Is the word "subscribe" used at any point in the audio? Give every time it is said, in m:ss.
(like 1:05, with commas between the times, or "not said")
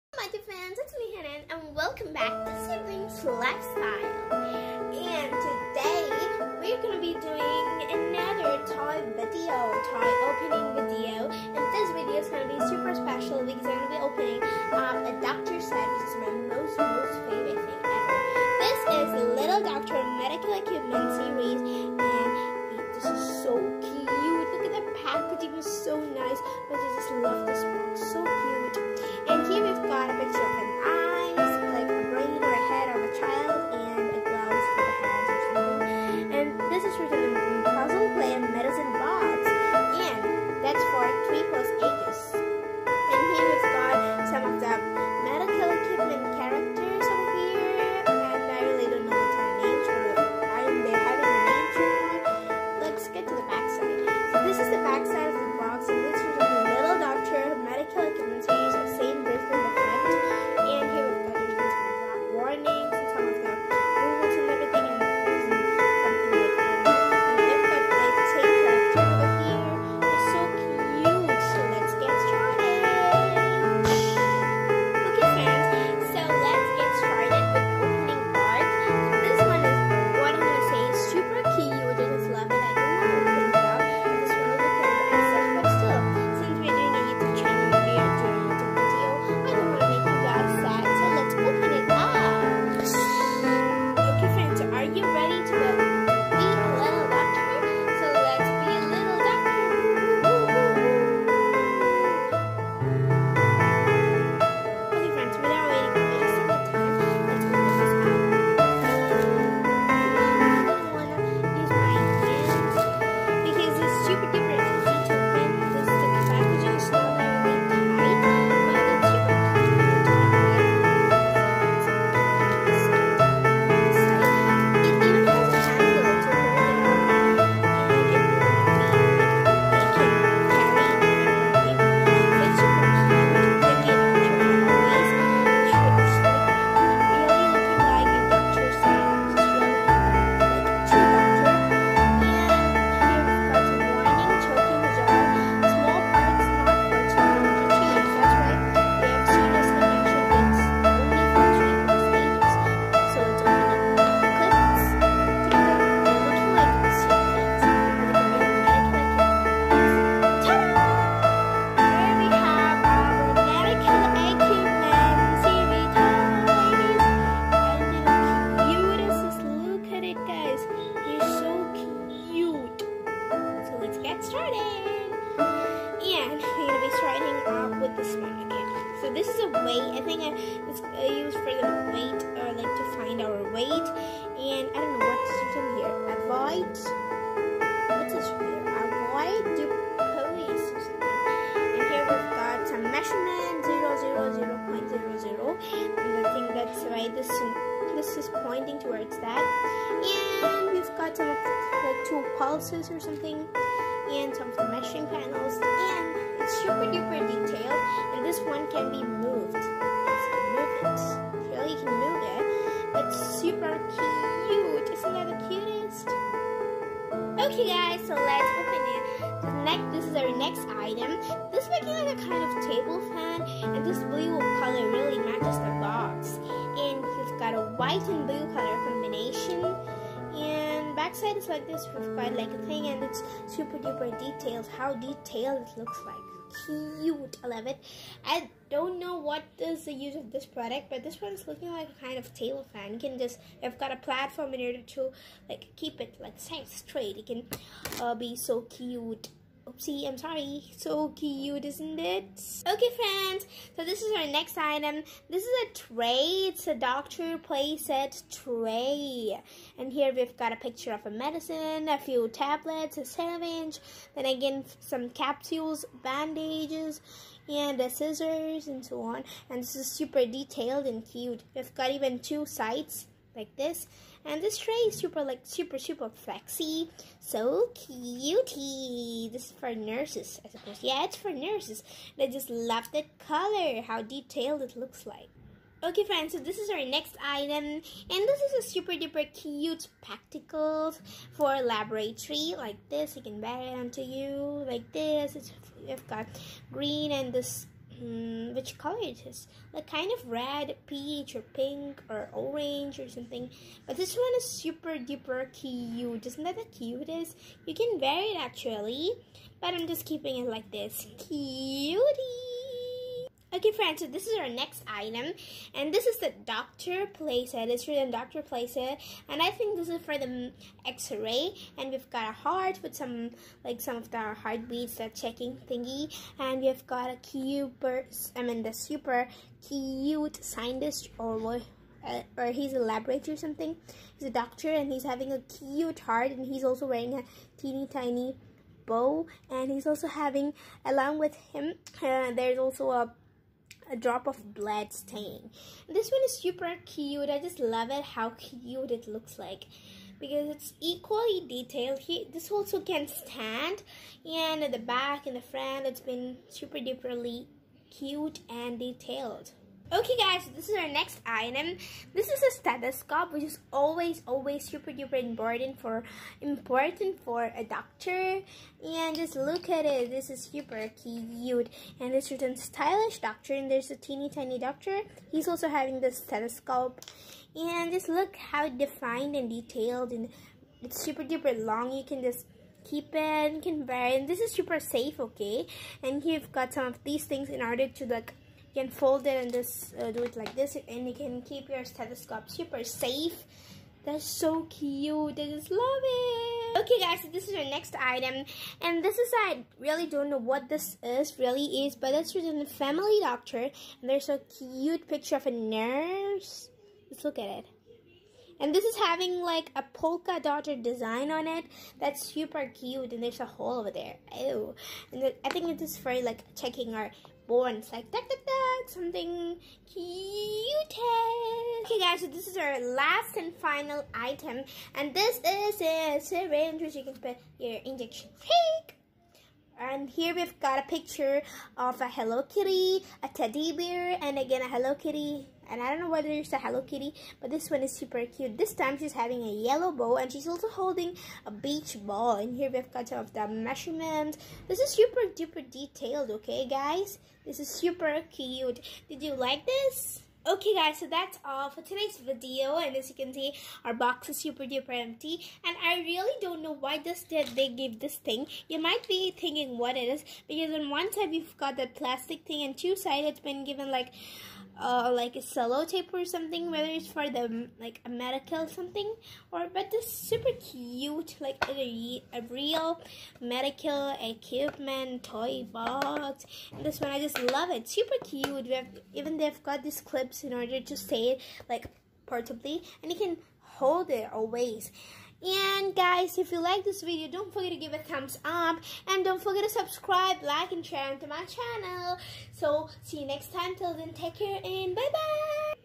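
8:09.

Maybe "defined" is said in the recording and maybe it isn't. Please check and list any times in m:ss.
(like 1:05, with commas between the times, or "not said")
6:18.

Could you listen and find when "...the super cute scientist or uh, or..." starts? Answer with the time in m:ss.
5:28.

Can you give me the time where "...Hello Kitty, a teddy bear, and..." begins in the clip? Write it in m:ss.
7:12.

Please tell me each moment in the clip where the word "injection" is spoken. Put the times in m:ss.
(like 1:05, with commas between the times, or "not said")
7:07.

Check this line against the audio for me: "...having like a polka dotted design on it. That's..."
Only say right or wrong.
right.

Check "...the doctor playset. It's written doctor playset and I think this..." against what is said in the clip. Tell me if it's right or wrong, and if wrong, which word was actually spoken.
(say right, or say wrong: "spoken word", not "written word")
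right.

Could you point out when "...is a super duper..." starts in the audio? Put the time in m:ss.
4:48.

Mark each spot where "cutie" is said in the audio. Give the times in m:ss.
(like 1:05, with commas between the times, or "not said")
4:37, 5:11.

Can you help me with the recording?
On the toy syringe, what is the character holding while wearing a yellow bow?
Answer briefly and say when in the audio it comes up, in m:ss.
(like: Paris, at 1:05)
a beach ball, at 7:21.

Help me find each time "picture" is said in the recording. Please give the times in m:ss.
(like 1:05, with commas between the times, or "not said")
4:20, 6:45, 7:10.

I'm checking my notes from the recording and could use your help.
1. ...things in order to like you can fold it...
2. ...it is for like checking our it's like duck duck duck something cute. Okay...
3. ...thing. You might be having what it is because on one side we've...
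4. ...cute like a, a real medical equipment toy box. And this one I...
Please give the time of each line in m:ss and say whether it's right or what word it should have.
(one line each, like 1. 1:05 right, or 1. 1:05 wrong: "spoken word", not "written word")
1. 6:27 right
2. 6:55 right
3. 7:38 wrong: "thinking", not "having"
4. 7:50 right.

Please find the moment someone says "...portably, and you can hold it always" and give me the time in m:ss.
8:02.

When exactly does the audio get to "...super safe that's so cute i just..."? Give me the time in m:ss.
6:32.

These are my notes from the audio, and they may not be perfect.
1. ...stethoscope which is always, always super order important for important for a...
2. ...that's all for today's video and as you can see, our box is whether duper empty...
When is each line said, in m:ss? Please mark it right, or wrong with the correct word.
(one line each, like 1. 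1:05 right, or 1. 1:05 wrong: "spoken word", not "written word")
1. 6:02 wrong: "duper", not "order"
2. 7:31 wrong: "super", not "whether".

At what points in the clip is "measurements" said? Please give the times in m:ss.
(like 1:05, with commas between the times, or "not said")
7:23.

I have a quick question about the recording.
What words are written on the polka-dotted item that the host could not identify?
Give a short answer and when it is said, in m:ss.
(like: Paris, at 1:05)
Family doctor, at 6:42.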